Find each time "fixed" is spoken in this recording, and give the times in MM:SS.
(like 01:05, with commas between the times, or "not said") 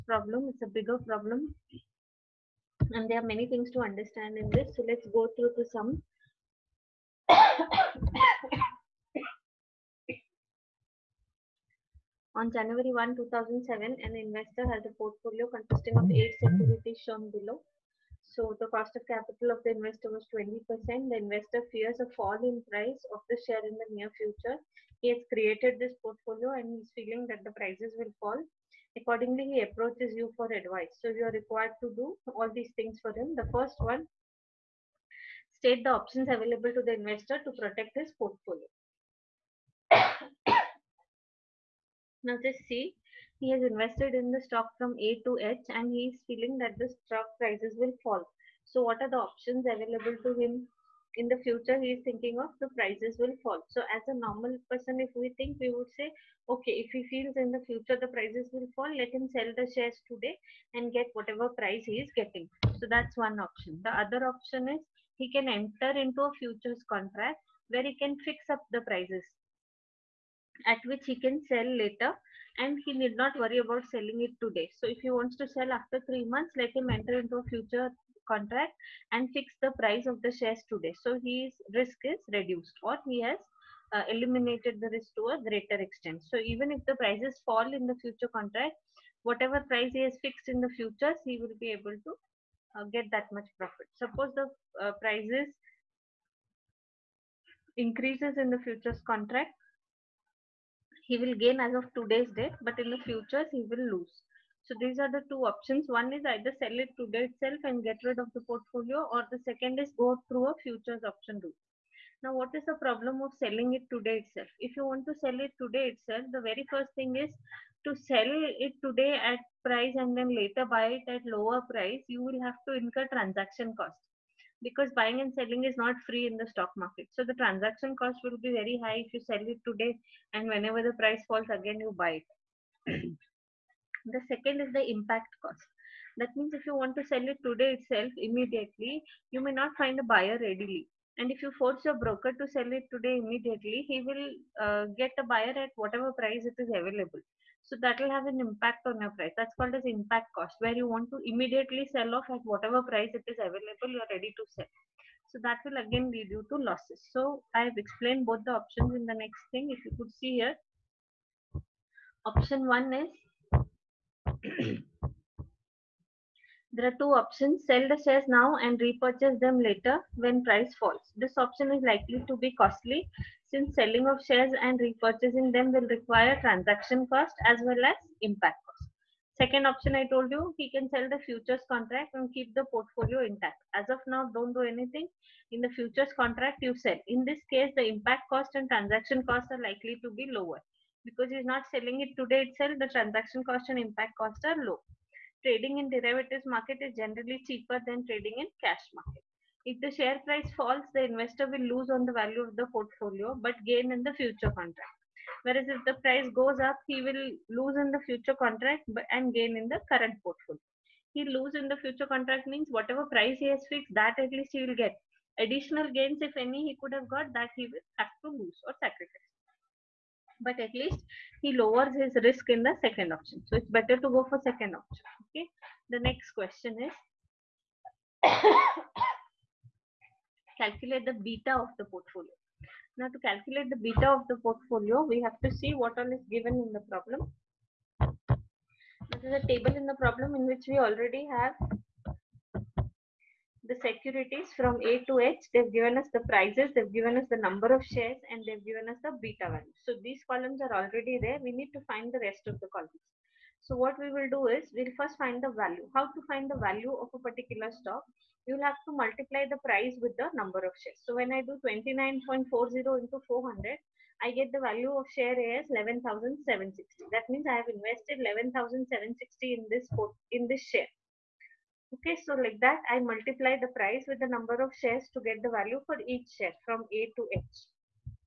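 01:30, 03:33.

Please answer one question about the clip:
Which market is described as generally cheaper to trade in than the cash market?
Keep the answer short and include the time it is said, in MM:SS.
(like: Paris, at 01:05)
derivatives market, at 03:15.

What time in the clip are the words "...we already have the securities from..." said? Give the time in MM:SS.
04:00.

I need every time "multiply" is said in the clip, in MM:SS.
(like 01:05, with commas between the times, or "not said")
04:18, 04:32.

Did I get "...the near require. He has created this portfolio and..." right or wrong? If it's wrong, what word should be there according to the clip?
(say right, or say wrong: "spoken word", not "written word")
wrong: "future", not "require".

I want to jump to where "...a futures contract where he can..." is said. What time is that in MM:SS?
01:06.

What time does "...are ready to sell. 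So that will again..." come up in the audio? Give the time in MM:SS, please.
02:34.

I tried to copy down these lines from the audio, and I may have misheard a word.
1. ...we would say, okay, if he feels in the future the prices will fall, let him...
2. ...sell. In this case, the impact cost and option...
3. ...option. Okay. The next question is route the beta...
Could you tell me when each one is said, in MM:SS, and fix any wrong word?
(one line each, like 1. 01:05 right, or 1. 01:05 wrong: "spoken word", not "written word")
1. 00:55 right
2. 03:06 wrong: "transaction", not "option"
3. 03:44 wrong: "calculate", not "route".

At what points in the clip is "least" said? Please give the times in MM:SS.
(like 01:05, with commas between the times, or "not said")
03:34, 03:40.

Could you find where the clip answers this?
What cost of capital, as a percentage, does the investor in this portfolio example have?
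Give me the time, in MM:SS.
00:20.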